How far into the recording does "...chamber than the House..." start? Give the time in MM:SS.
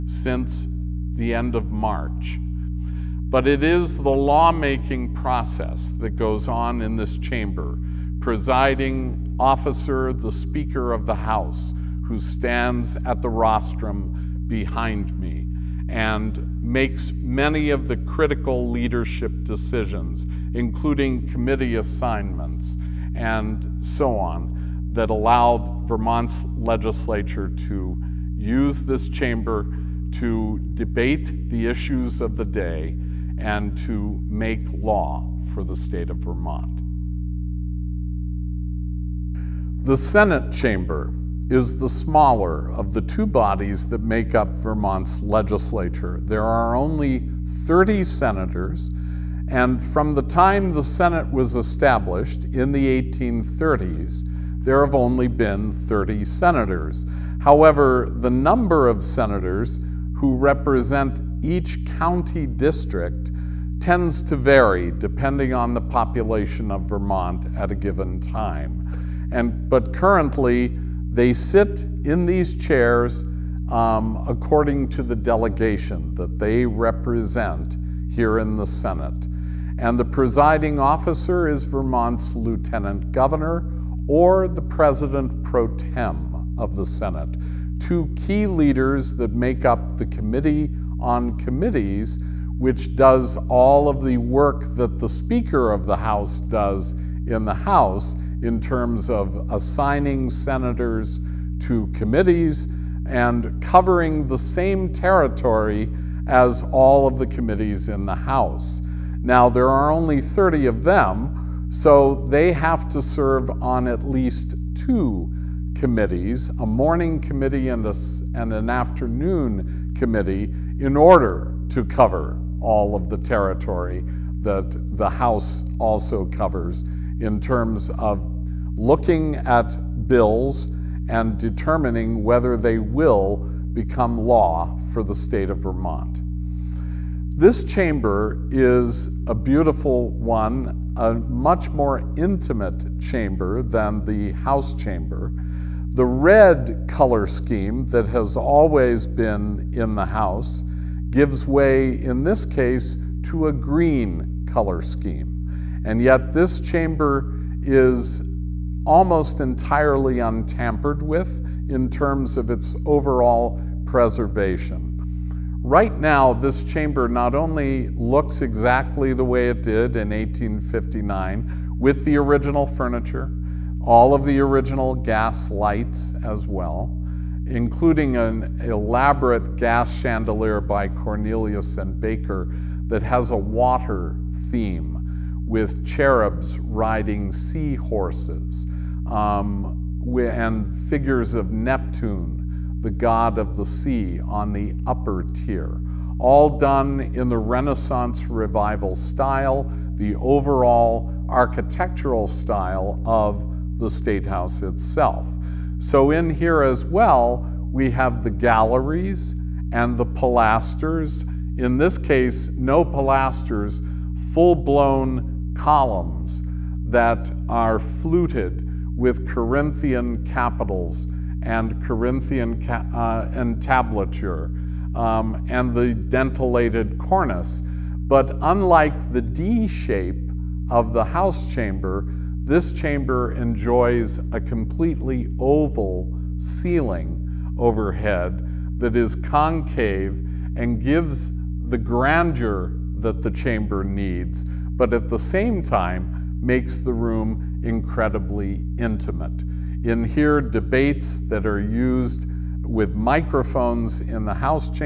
02:22.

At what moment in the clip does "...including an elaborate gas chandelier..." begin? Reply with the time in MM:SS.
02:57.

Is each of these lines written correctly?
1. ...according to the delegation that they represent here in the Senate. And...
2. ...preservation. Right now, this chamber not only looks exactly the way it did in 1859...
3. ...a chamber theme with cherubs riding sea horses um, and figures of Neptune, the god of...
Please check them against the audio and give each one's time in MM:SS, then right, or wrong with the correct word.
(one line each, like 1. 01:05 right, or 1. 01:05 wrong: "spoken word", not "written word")
1. 01:14 right
2. 02:43 right
3. 03:03 wrong: "water", not "chamber".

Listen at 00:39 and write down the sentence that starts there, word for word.
The Senate chamber is the smaller of the two bodies that make up Vermont's legislature.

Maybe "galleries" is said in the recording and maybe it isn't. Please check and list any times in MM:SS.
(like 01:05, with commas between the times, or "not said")
03:28.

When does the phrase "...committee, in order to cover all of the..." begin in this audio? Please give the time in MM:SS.
01:59.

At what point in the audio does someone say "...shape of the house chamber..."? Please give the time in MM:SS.
03:49.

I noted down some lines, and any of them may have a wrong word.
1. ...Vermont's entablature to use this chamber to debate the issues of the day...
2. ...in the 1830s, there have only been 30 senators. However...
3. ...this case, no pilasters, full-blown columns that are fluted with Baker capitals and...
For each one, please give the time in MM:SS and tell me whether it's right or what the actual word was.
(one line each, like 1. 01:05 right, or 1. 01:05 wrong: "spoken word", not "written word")
1. 00:25 wrong: "legislature", not "entablature"
2. 00:52 right
3. 03:31 wrong: "Corinthian", not "Baker".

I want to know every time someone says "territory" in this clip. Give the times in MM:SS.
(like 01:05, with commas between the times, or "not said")
01:44, 02:03.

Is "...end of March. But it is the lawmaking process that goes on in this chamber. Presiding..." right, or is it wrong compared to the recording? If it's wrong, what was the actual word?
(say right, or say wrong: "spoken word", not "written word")
right.